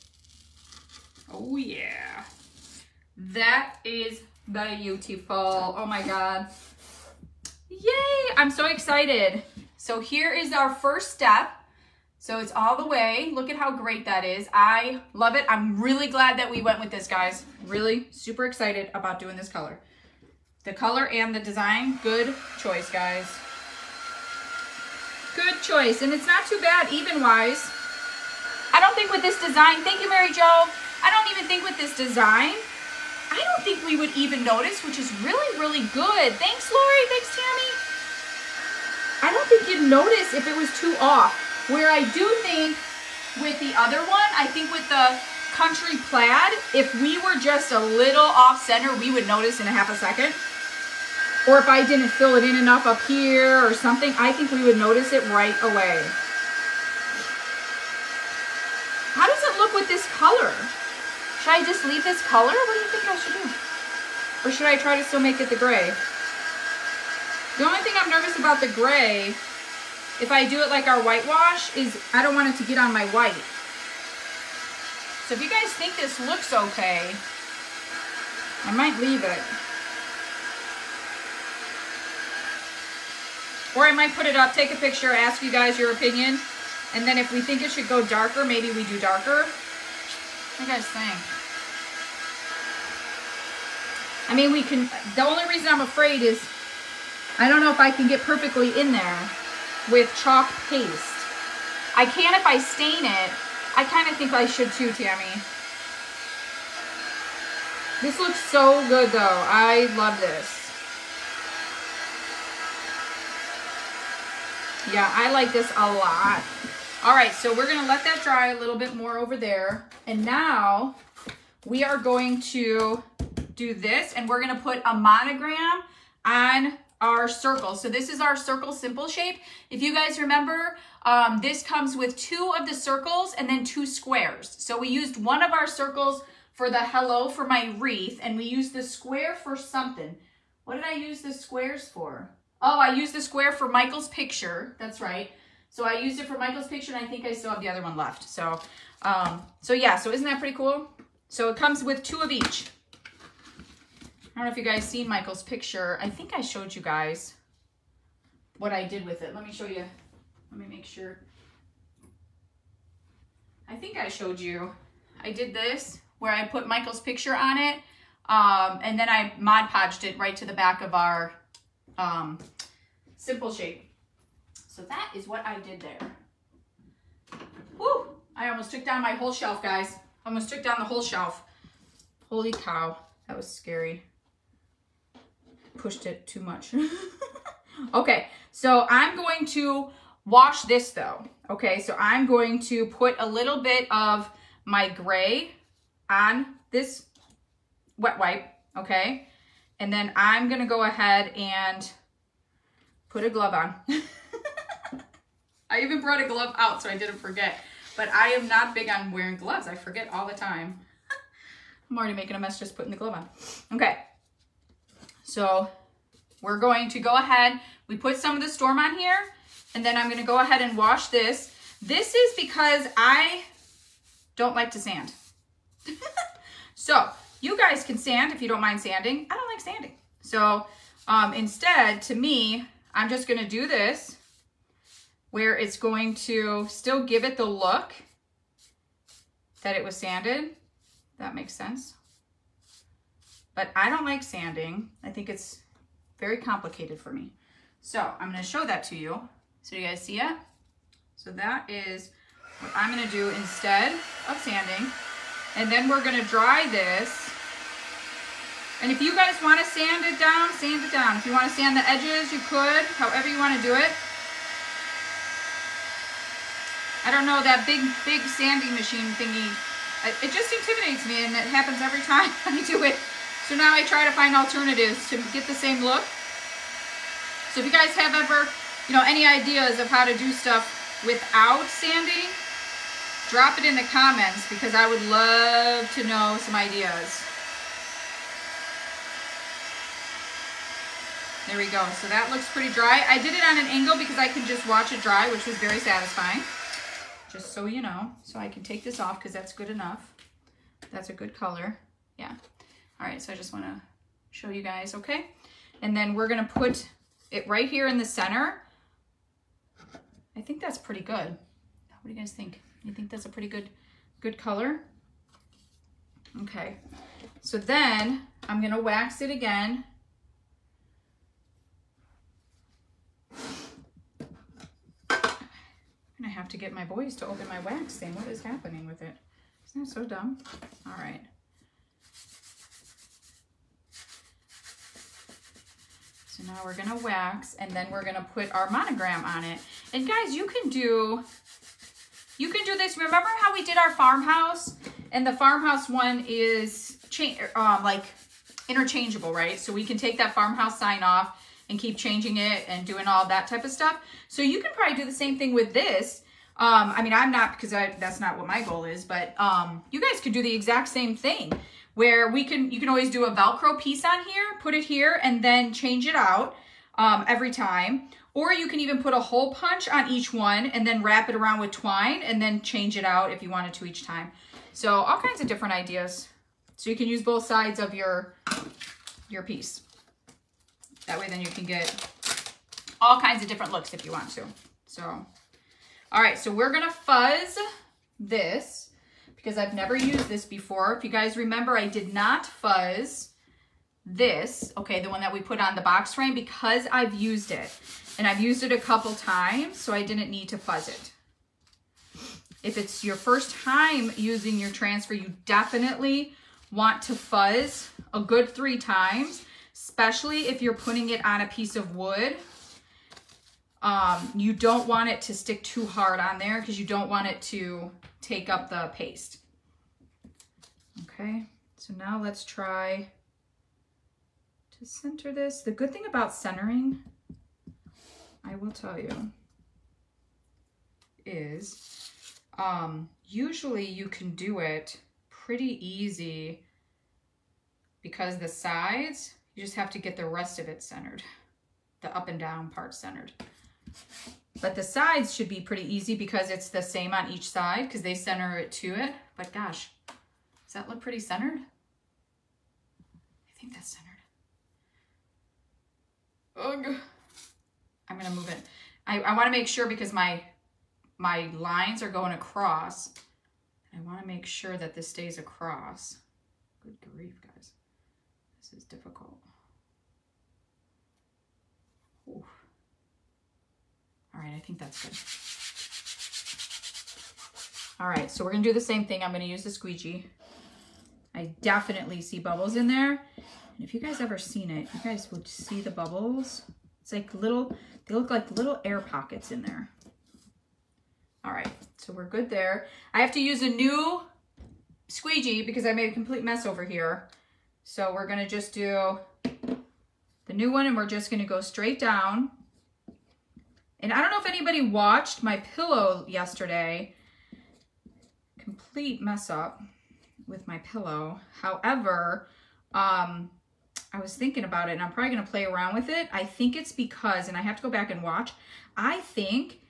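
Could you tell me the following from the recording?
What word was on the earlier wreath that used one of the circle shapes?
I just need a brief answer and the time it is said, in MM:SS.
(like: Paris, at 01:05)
hello, at 02:16.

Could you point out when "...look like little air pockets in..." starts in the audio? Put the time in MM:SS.
08:08.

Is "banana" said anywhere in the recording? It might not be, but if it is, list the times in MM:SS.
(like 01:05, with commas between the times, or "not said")
not said.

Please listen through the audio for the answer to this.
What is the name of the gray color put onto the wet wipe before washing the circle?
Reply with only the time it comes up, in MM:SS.
03:38.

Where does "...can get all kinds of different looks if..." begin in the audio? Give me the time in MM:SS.
06:21.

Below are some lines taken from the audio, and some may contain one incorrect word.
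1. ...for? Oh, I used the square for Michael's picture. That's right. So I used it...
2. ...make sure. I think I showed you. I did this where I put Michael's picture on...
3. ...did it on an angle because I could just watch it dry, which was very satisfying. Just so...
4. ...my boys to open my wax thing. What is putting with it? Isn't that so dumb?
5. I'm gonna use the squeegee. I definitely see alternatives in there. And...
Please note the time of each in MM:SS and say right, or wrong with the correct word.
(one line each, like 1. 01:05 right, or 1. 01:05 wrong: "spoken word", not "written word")
1. 02:21 right
2. 02:40 right
3. 04:53 right
4. 05:26 wrong: "happening", not "putting"
5. 07:59 wrong: "bubbles", not "alternatives".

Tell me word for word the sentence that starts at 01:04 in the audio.
Or should I try to still make it the gray?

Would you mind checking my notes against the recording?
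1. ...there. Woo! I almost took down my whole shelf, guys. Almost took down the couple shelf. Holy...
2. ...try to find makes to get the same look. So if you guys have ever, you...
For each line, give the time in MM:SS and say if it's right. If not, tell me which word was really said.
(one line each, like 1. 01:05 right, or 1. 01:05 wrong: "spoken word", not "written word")
1. 02:55 wrong: "whole", not "couple"
2. 04:33 wrong: "alternatives", not "makes".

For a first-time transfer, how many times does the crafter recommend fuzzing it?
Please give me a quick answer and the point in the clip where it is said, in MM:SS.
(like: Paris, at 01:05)
3, at 06:48.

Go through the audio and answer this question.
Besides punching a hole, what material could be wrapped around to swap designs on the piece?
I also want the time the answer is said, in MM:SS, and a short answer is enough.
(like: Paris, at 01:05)
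twine, at 06:11.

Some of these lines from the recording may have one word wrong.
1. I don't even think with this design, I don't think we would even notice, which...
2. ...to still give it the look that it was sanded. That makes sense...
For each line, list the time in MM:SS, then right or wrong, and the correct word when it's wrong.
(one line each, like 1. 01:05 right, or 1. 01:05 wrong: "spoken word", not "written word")
1. 00:31 right
2. 03:56 right.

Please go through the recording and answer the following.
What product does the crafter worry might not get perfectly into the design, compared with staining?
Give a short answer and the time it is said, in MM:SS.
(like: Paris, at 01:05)
chalk paste, at 01:40.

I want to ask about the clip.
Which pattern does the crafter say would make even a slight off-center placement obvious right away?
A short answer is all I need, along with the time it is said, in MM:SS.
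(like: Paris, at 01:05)
country plaid, at 00:45.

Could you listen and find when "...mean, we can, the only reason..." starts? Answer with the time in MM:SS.
01:34.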